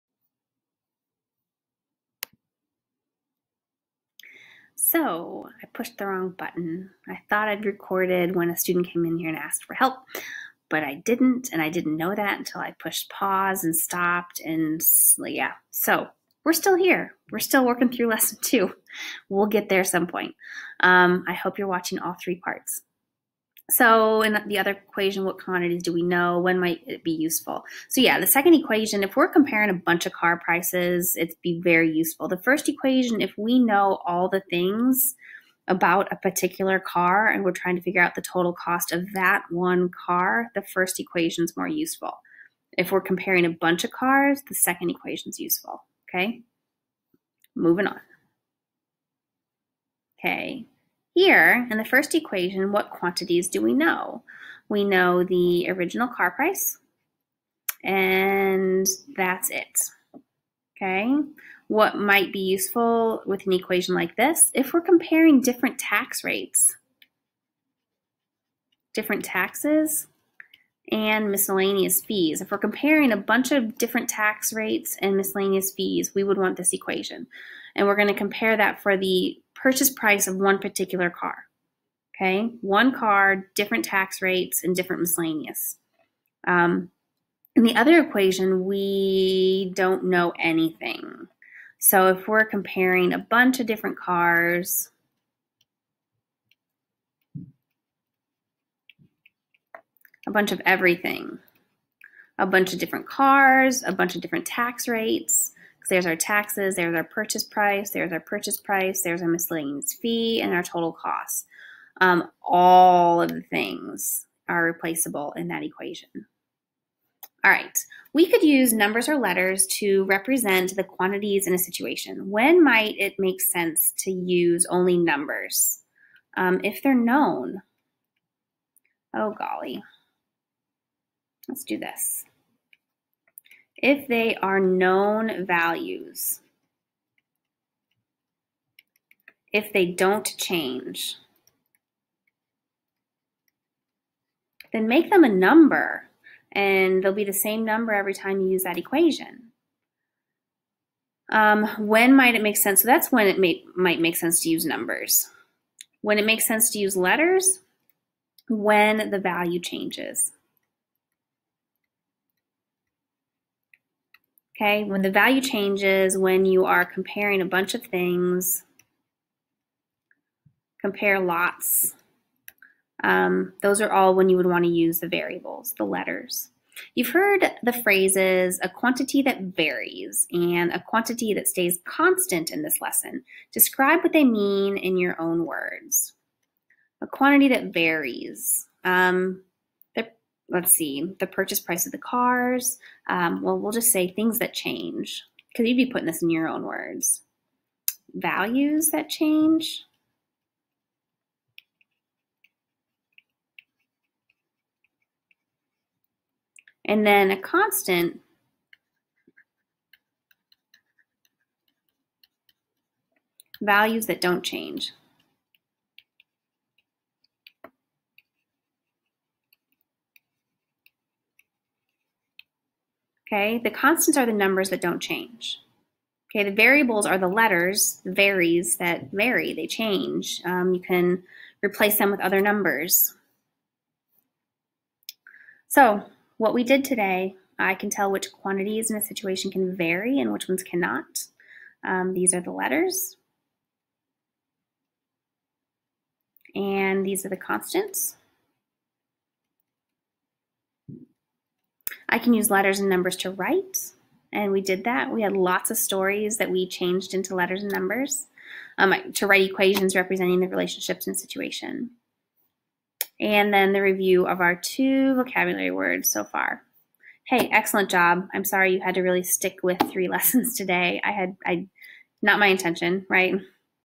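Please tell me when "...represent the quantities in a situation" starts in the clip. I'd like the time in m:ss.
2:00.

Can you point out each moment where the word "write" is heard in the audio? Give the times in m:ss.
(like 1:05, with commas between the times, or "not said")
4:13, 4:19.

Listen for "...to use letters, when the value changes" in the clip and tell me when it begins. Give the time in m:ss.
2:36.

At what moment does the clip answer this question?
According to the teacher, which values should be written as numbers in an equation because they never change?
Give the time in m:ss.
2:14.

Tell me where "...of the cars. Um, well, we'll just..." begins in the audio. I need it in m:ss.
3:11.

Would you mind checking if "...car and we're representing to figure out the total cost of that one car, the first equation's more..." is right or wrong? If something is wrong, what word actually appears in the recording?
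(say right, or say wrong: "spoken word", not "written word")
wrong: "trying", not "representing".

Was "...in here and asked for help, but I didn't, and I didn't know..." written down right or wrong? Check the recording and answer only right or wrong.
right.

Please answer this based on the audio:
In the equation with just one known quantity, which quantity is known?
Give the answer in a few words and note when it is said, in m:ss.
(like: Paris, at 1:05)
Original car price, at 0:55.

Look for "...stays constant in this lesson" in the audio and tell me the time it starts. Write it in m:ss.
3:01.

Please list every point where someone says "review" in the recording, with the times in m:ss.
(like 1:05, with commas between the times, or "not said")
4:23.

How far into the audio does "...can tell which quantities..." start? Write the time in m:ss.
3:57.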